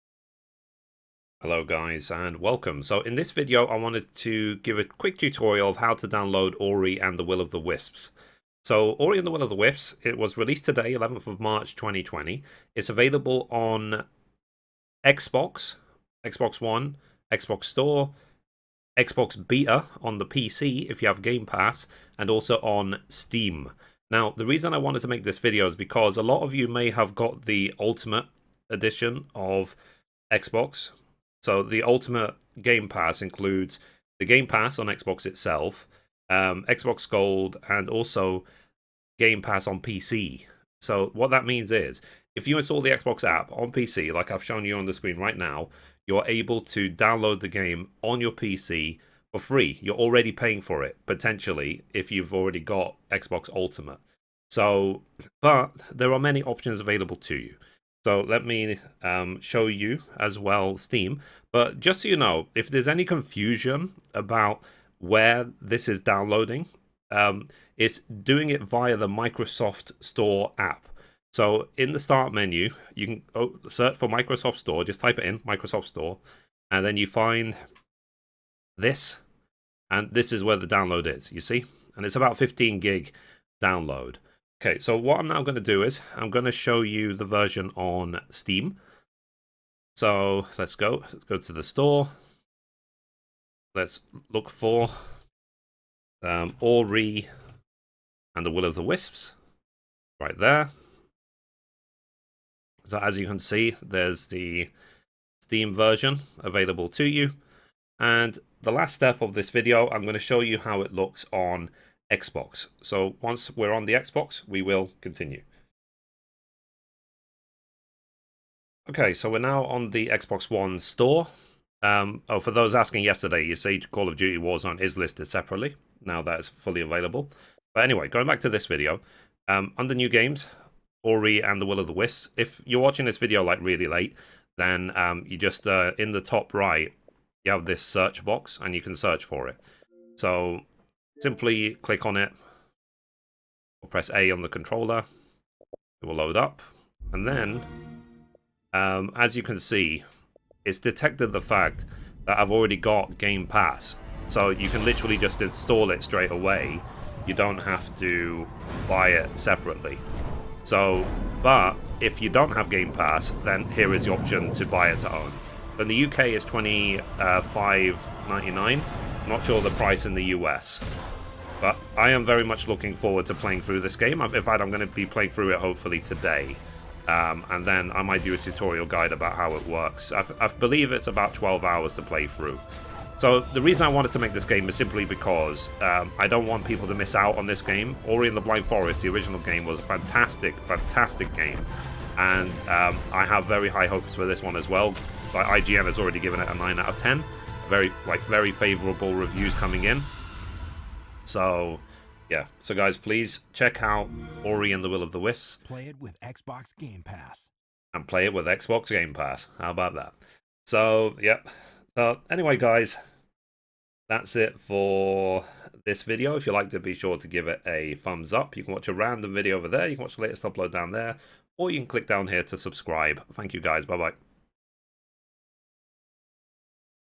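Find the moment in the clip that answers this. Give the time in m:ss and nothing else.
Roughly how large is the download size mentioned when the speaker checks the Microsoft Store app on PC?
1:22.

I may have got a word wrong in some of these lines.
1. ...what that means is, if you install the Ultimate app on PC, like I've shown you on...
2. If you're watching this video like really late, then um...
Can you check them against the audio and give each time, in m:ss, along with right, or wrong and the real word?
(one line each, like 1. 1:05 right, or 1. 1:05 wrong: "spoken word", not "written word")
1. 0:41 wrong: "Xbox", not "Ultimate"
2. 2:12 right.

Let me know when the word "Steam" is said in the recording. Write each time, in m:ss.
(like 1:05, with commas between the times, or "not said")
0:23, 1:00, 1:28, 1:45.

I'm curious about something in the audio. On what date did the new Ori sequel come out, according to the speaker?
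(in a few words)
11th of March 2020.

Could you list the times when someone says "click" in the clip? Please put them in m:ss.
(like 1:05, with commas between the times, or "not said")
2:21, 3:41.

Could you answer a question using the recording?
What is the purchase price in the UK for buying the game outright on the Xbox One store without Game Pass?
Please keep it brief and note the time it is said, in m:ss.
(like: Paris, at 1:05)
25.99, at 2:46.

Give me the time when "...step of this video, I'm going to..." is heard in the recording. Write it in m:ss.
1:48.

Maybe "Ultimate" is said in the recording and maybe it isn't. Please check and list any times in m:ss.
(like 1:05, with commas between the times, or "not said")
0:27, 0:31, 0:53.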